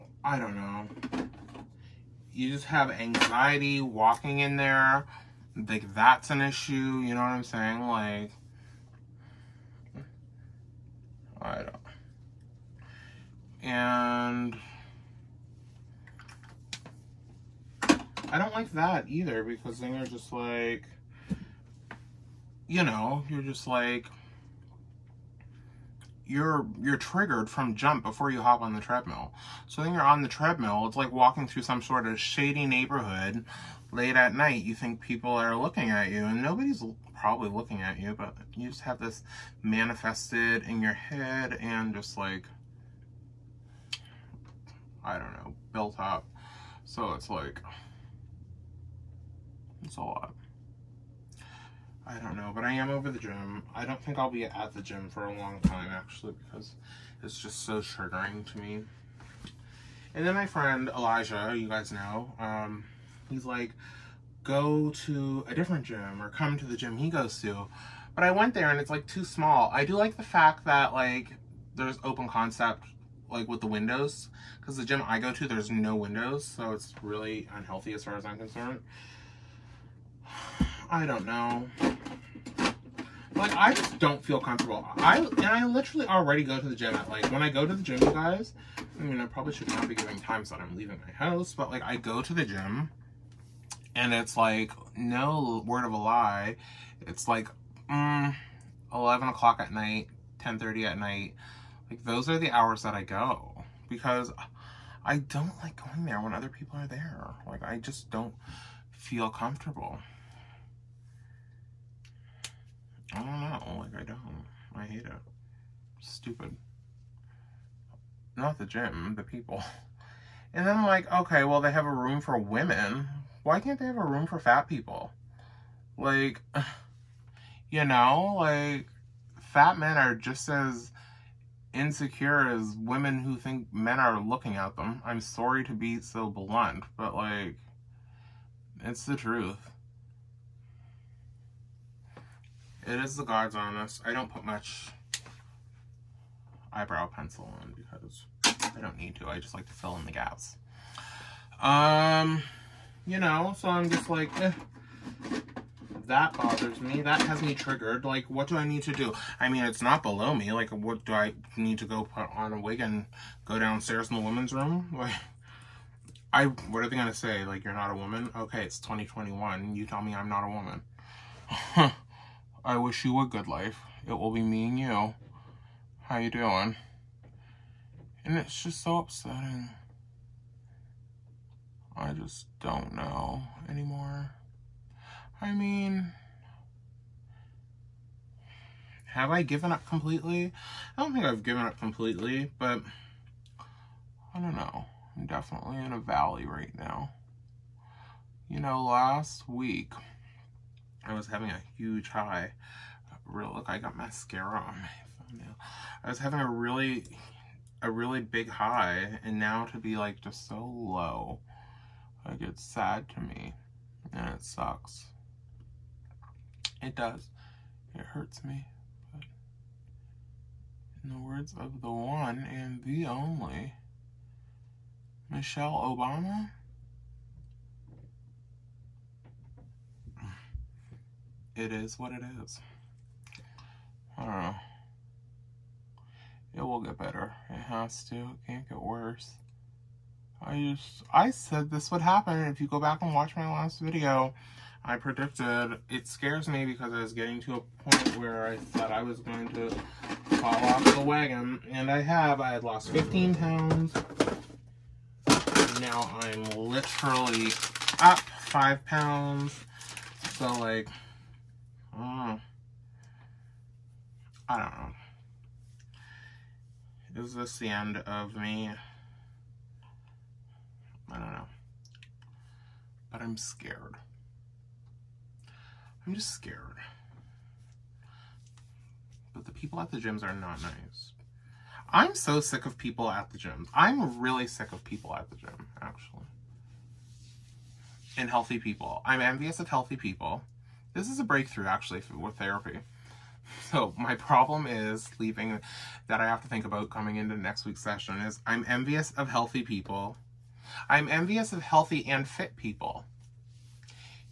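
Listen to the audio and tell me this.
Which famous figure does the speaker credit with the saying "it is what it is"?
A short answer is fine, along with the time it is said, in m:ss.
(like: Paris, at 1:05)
Michelle Obama, at 3:45.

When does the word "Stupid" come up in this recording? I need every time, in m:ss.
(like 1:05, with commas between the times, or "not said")
1:56.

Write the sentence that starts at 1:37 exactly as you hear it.
It's like mm, 11 o'clock at night, 10.30 at night.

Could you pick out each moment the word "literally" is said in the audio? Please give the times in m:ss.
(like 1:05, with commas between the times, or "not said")
1:25, 4:16.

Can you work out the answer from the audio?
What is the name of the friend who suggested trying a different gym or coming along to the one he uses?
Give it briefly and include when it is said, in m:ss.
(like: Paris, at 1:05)
Elijah, at 1:00.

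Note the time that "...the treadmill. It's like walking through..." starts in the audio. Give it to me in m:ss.
0:30.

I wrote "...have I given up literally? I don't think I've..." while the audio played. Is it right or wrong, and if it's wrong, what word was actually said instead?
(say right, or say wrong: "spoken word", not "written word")
wrong: "completely", not "literally".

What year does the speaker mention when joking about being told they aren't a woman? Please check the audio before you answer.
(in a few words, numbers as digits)
2021.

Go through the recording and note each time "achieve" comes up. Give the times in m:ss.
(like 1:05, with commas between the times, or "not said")
not said.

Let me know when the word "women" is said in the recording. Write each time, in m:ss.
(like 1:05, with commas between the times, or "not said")
2:02, 2:12, 2:44.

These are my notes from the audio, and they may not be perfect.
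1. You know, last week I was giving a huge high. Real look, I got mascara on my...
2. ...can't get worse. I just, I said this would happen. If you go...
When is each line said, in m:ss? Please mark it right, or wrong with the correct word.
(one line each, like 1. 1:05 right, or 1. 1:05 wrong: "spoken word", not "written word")
1. 3:18 wrong: "having", not "giving"
2. 3:58 right.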